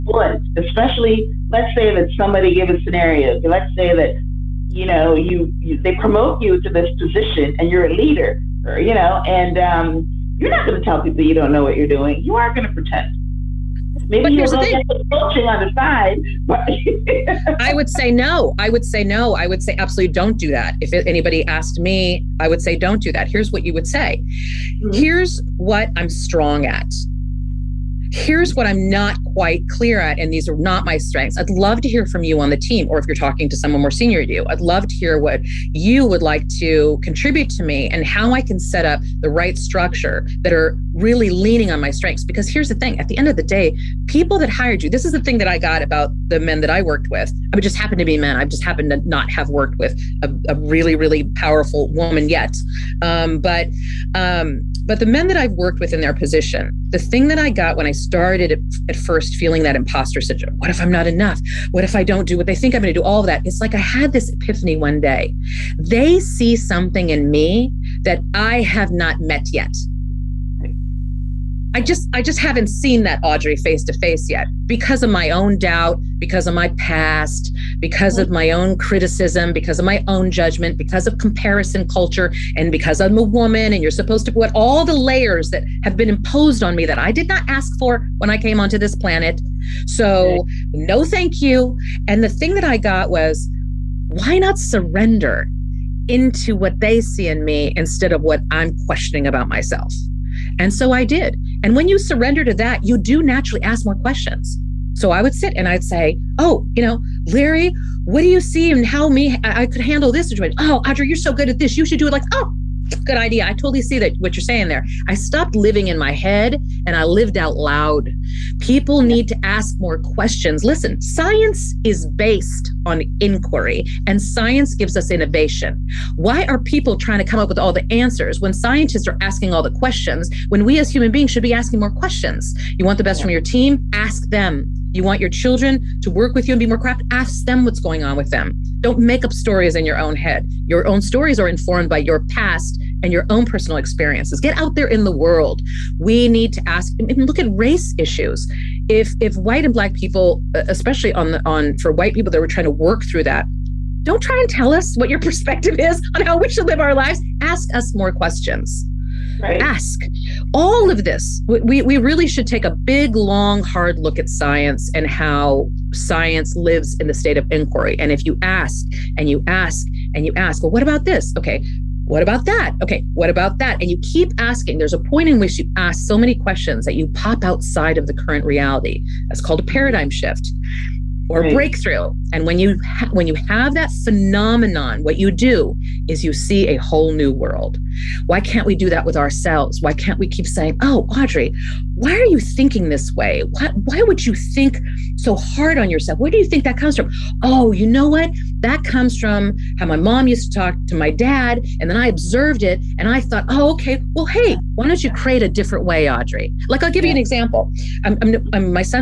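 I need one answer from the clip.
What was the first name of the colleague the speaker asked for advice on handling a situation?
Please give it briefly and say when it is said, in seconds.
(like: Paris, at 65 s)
Larry, at 107 s.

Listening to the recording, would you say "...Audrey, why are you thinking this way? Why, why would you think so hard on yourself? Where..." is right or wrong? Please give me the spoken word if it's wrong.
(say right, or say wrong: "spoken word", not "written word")
right.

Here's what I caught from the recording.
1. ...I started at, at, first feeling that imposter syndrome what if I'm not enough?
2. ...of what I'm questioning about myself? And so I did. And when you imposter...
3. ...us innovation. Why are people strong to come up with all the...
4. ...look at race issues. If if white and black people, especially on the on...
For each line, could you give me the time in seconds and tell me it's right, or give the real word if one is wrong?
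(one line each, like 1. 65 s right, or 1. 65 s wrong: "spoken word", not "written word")
1. 57 s right
2. 98 s wrong: "surrender", not "imposter"
3. 124 s wrong: "trying", not "strong"
4. 147 s right.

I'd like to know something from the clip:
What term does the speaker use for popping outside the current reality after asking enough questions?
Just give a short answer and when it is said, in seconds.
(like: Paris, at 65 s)
Paradigm shift, at 179 s.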